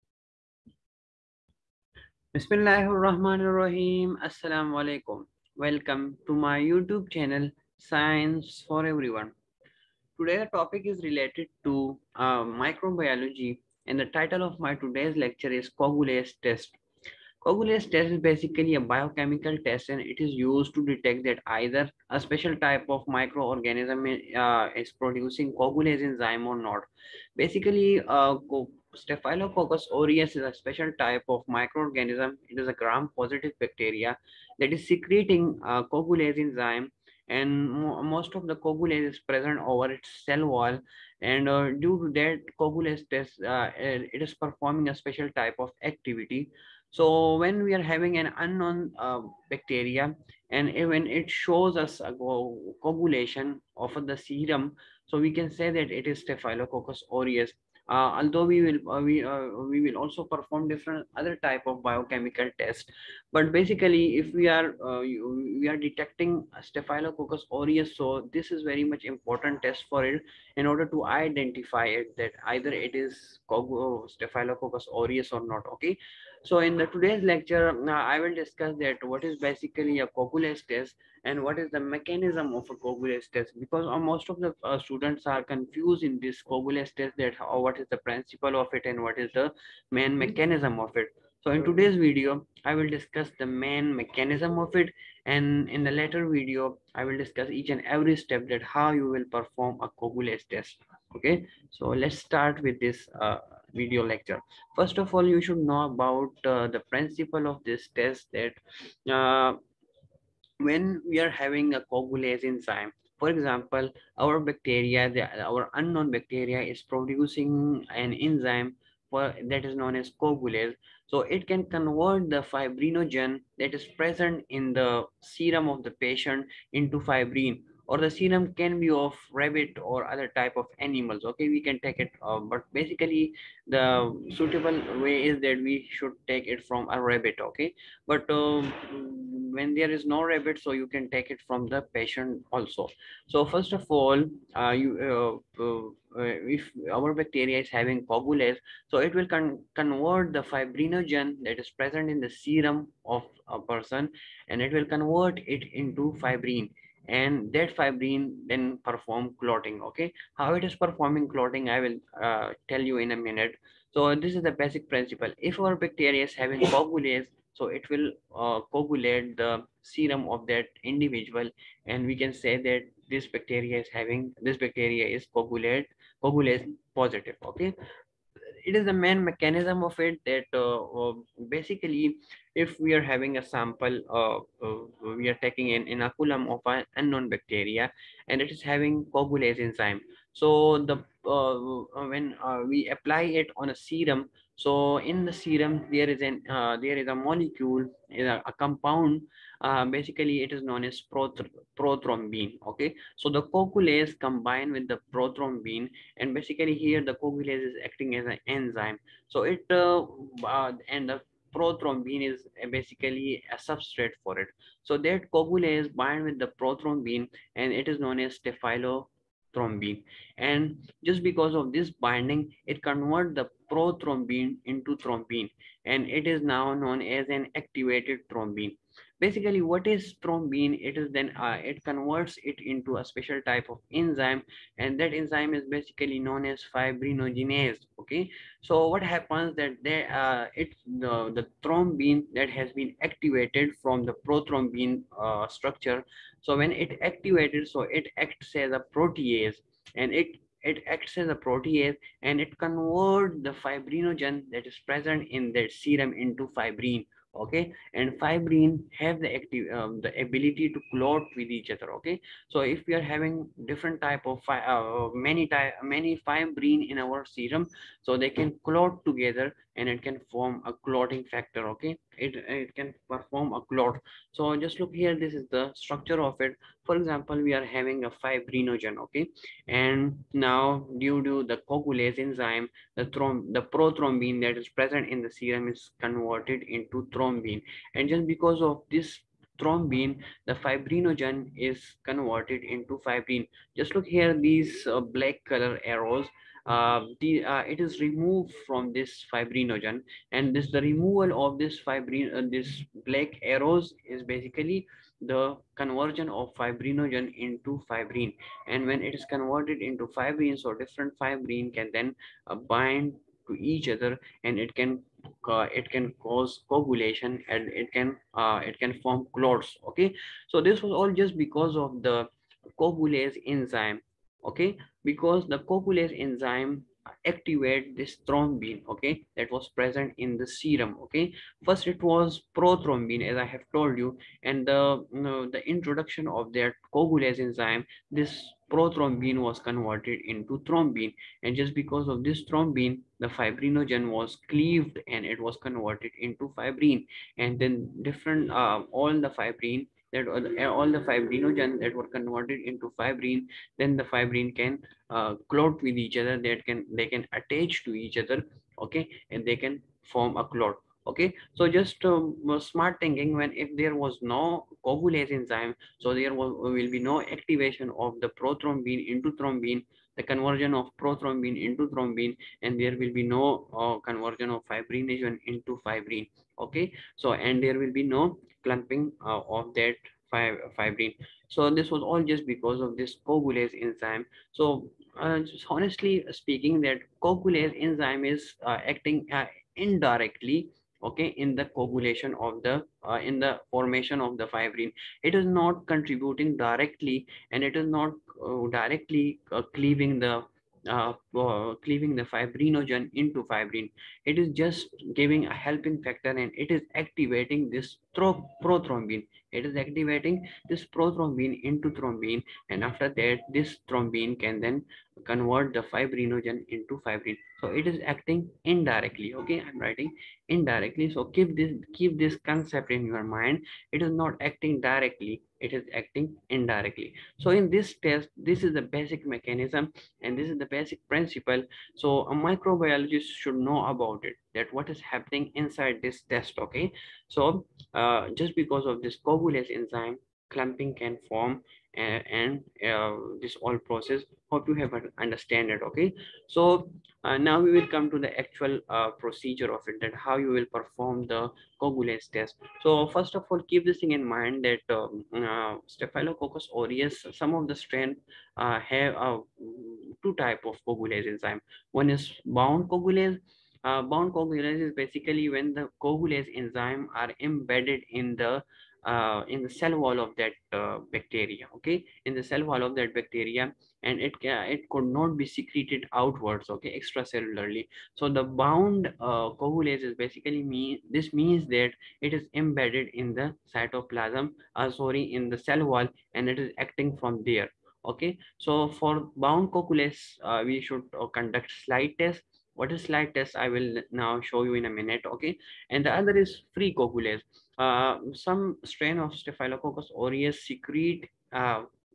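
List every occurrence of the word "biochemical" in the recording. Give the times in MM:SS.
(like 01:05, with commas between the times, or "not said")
00:18, 01:01.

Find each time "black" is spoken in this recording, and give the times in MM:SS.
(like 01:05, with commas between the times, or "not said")
04:55, 05:03.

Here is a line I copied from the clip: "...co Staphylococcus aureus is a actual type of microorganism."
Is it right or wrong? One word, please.
wrong.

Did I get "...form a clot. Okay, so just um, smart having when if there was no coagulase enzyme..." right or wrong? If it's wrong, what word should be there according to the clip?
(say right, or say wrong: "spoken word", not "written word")
wrong: "thinking", not "having".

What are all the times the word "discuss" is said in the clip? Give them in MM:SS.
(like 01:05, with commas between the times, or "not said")
01:18, 01:32, 01:37.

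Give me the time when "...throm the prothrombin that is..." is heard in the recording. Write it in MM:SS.
04:43.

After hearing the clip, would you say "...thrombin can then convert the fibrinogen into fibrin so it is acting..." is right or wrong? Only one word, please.
right.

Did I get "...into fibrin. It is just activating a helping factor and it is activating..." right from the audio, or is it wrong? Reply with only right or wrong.
wrong.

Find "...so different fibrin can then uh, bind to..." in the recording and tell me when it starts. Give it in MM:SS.
05:10.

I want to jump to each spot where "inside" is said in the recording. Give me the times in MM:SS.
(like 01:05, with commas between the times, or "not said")
07:15.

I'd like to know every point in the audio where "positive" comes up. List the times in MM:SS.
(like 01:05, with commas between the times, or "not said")
00:32, 02:56.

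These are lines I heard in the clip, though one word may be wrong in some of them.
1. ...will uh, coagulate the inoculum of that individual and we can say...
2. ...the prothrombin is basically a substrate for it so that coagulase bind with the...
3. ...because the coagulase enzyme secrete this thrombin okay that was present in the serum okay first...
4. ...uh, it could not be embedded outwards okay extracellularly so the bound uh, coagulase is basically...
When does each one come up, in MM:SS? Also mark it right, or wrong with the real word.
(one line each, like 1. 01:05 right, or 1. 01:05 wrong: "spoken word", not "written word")
1. 02:47 wrong: "serum", not "inoculum"
2. 03:31 right
3. 05:25 wrong: "activate", not "secrete"
4. 07:54 wrong: "secreted", not "embedded".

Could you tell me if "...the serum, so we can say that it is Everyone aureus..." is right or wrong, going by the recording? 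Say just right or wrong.
wrong.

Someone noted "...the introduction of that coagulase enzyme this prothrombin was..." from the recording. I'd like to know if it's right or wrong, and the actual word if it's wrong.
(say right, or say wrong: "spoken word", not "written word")
right.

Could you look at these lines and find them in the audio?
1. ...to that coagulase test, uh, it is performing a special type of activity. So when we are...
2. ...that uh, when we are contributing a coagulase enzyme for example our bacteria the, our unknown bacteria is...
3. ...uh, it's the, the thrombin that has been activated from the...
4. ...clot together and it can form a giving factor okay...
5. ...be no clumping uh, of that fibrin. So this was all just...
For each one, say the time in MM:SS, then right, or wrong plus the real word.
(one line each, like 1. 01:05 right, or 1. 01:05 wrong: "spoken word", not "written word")
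1. 00:42 right
2. 01:48 wrong: "having", not "contributing"
3. 04:00 right
4. 04:28 wrong: "clotting", not "giving"
5. 06:17 right.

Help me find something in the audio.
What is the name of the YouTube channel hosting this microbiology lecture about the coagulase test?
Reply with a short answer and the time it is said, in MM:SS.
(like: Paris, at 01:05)
Science for Everyone, at 00:07.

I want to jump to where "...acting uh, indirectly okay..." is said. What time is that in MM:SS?
06:28.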